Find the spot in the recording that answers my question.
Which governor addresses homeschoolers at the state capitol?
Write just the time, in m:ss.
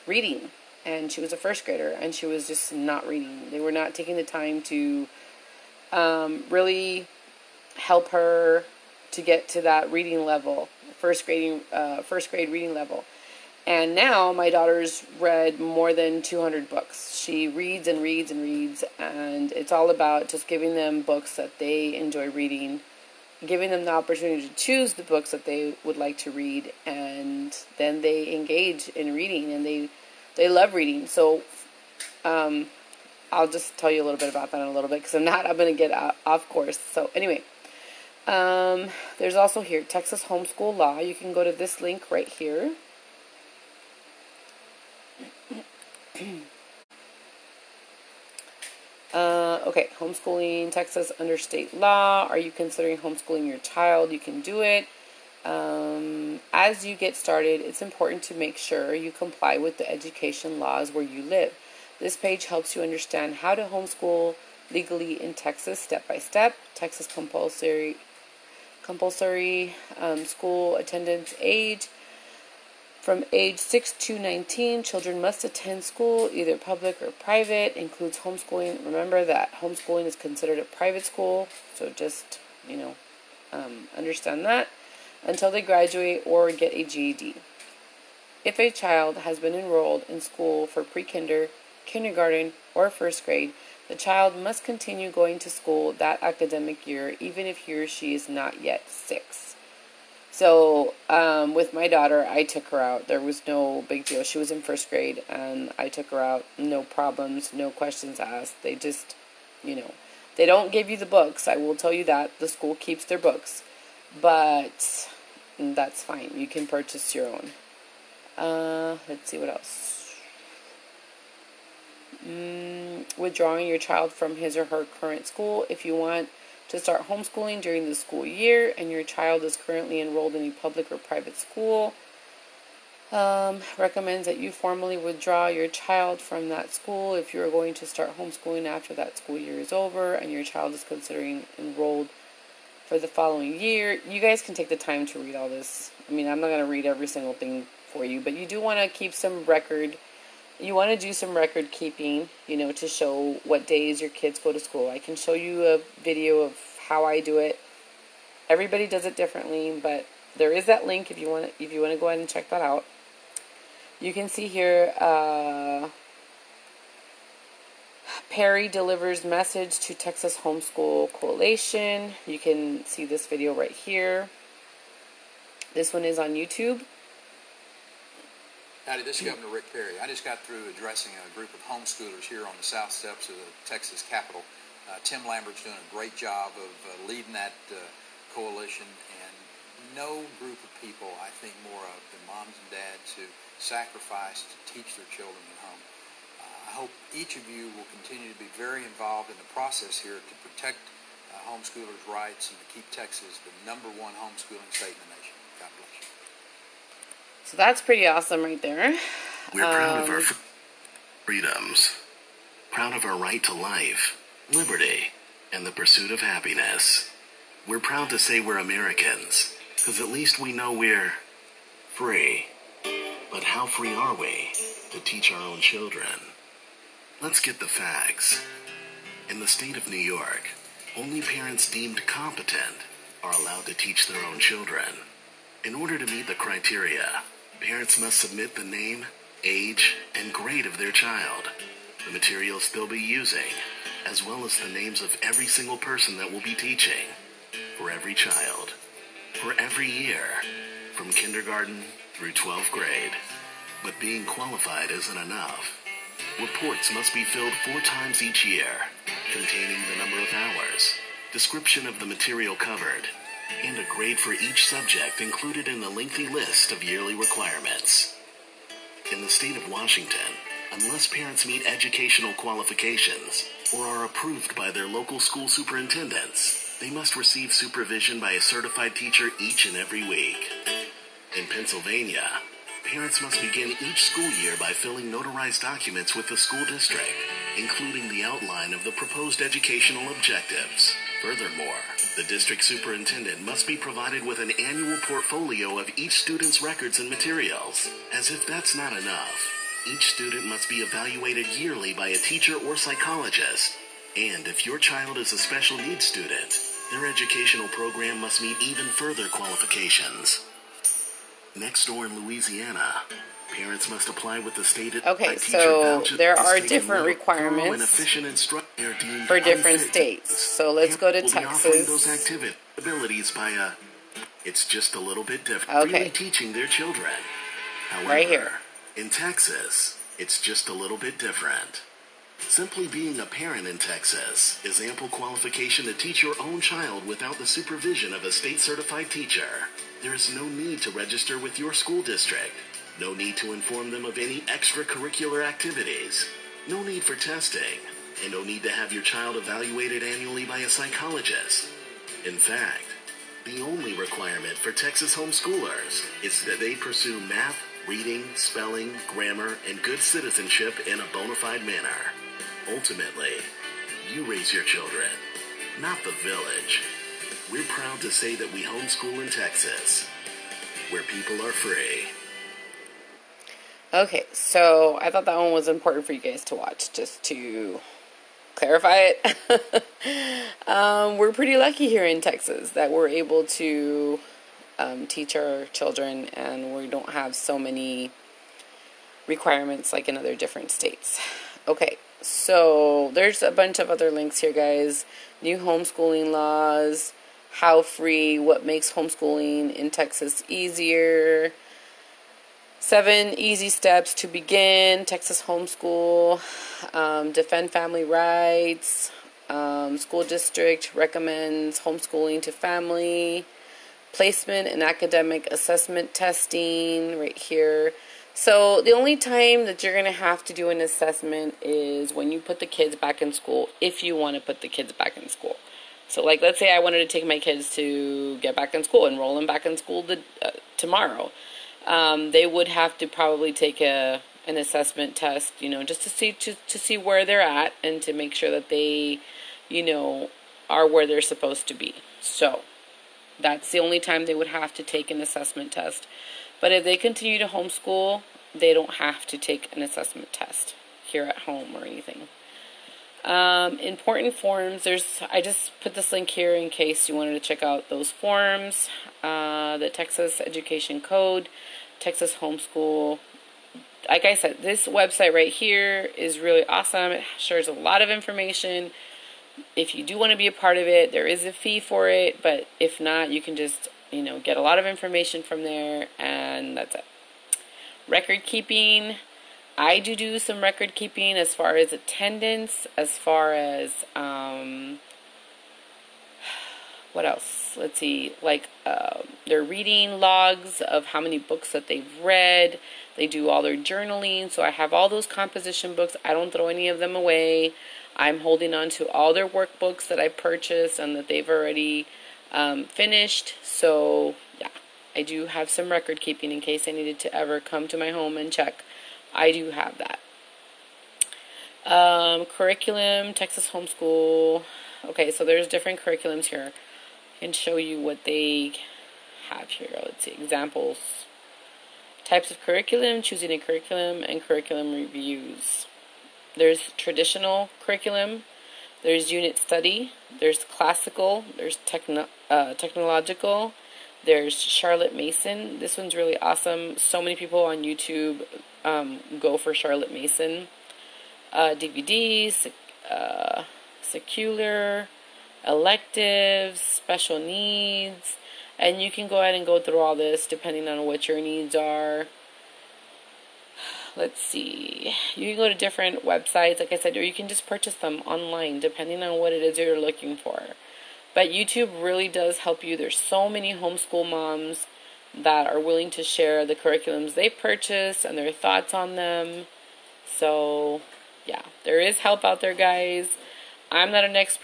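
2:59.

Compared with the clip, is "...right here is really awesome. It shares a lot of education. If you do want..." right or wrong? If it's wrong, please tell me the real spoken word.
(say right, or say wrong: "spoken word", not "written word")
wrong: "information", not "education".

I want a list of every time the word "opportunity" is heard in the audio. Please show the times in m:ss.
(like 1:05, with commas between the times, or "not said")
0:23.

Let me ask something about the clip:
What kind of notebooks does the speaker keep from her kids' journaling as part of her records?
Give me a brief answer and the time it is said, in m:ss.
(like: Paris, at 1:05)
Composition books, at 8:15.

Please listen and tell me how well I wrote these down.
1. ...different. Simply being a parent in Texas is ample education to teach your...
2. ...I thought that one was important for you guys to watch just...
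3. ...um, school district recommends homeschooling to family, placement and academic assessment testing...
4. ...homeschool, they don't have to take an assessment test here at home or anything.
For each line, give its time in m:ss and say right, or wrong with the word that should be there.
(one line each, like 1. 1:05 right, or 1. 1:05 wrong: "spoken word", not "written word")
1. 5:31 wrong: "qualification", not "education"
2. 6:15 right
3. 6:49 right
4. 7:27 right.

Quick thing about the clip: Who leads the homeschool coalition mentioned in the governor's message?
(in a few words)
Tim Lambert.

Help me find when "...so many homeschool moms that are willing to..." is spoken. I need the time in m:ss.
9:23.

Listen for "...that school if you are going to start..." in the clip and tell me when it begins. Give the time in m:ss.
2:16.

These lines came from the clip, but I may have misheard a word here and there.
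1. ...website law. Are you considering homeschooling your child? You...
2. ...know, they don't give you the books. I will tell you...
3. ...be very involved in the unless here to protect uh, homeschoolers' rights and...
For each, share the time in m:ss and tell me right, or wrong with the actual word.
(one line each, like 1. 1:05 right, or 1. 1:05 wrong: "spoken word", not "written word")
1. 0:51 wrong: "state", not "website"
2. 1:49 right
3. 3:18 wrong: "process", not "unless".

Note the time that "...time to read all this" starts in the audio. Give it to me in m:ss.
2:24.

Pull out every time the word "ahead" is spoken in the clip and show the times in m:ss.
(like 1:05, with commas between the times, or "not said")
2:42, 9:09.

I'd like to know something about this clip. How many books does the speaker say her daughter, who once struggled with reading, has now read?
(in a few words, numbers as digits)
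More than 200.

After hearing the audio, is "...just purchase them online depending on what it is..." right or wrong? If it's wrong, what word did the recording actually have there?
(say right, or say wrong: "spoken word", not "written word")
right.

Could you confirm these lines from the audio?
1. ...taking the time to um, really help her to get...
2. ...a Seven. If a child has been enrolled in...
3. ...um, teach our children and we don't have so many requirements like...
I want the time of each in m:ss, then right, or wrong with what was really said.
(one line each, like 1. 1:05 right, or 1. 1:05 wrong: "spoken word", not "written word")
1. 0:03 right
2. 1:26 wrong: "GED", not "Seven"
3. 6:24 right.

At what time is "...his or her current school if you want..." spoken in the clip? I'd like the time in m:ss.
2:04.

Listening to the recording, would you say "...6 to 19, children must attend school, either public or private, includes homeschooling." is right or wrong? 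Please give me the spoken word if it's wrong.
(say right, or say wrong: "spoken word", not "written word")
right.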